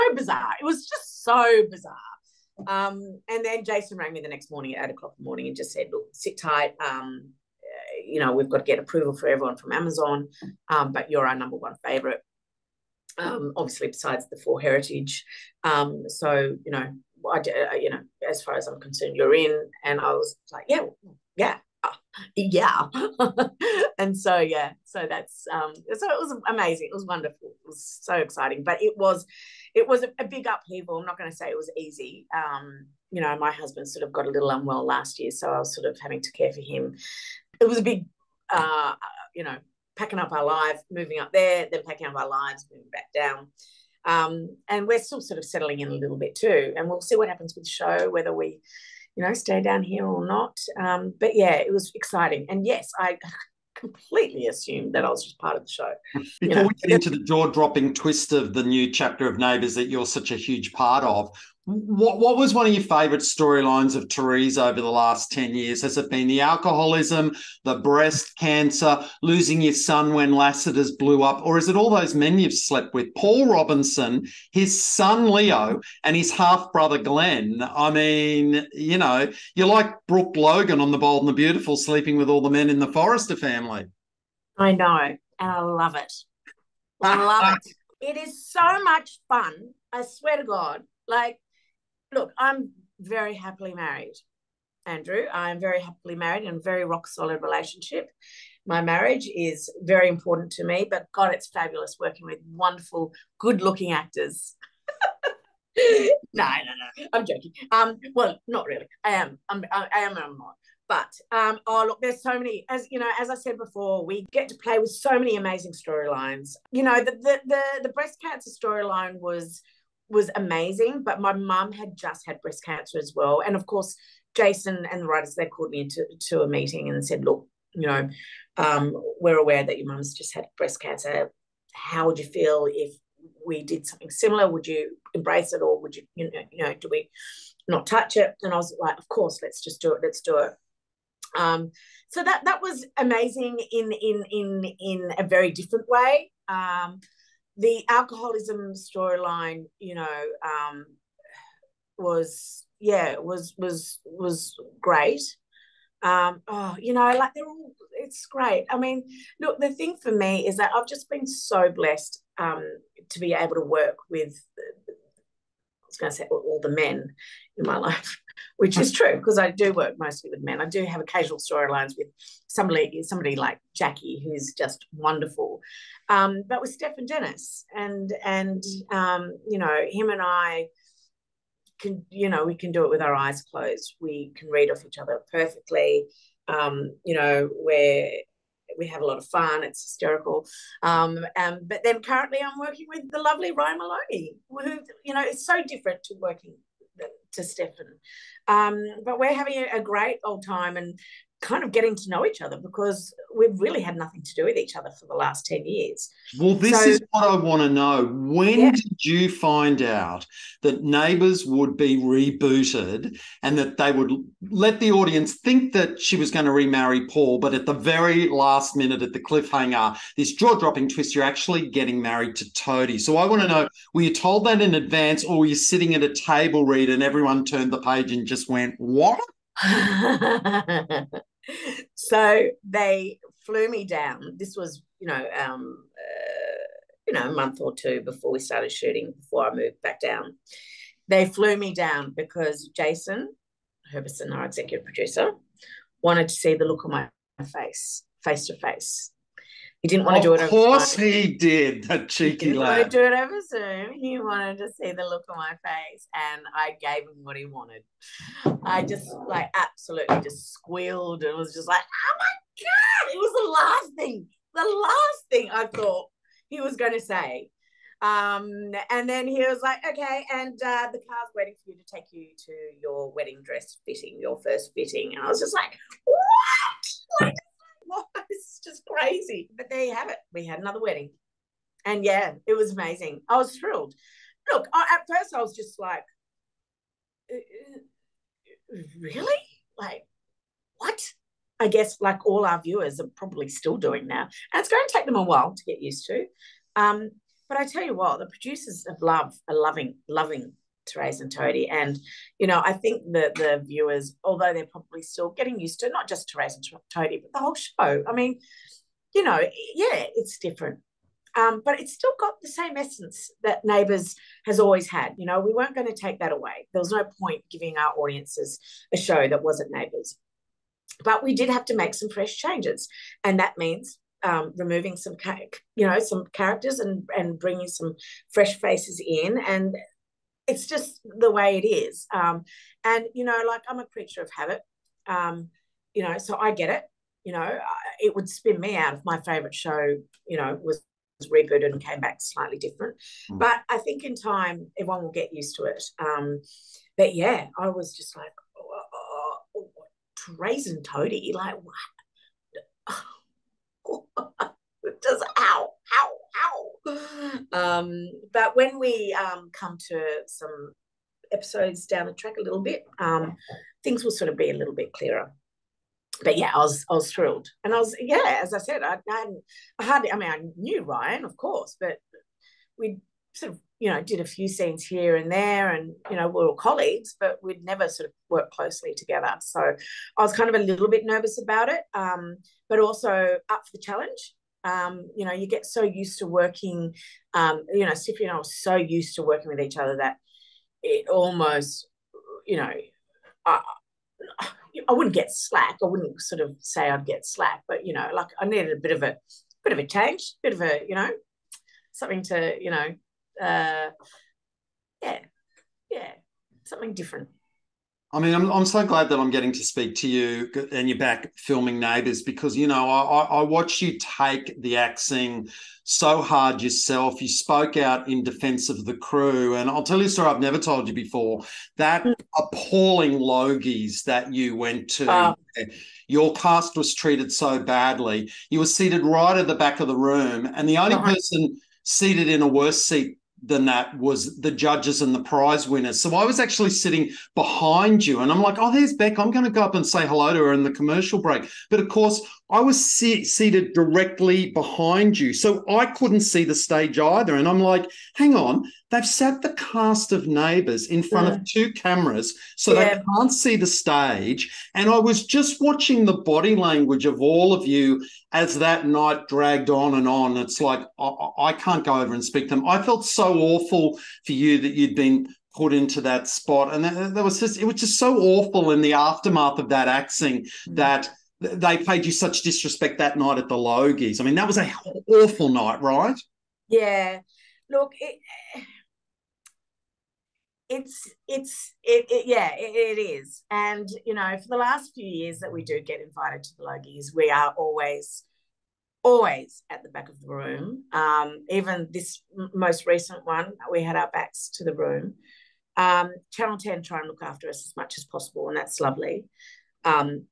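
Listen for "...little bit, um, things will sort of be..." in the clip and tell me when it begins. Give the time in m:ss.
6:02.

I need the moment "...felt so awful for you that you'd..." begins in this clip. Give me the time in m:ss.
7:42.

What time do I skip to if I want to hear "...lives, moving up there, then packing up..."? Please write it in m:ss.
0:40.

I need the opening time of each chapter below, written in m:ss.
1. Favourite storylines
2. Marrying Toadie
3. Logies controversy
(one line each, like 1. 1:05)
1. 1:04
2. 3:14
3. 6:50.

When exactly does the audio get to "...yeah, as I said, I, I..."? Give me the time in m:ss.
6:07.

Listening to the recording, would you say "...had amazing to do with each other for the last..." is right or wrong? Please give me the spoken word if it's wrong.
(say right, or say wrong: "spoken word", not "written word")
wrong: "nothing", not "amazing".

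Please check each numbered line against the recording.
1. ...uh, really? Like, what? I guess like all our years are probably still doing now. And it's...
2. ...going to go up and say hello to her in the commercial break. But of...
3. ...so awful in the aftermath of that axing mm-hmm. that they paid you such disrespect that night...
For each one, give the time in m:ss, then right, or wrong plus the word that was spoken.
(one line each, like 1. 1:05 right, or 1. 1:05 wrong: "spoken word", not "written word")
1. 4:48 wrong: "viewers", not "years"
2. 7:19 right
3. 7:47 right.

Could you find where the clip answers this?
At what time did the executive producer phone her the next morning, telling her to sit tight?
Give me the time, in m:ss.
0:04.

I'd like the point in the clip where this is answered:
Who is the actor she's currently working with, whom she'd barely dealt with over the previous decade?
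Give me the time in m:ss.
3:13.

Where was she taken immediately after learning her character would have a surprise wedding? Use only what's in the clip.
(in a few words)
Wedding dress fitting.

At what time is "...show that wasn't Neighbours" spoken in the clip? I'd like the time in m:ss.
5:18.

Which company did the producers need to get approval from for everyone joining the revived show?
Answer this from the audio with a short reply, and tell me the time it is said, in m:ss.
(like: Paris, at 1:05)
Amazon, at 0:09.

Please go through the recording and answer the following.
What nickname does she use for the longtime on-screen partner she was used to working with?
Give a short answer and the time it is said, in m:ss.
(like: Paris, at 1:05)
Siffy, at 6:27.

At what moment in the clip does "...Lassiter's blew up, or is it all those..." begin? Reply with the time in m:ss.
1:10.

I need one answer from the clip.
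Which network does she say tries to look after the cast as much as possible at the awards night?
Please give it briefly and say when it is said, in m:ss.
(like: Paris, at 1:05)
Channel 10, at 8:16.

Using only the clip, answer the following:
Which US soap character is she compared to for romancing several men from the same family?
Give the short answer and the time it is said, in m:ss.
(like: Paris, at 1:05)
Brooke Logan, at 1:20.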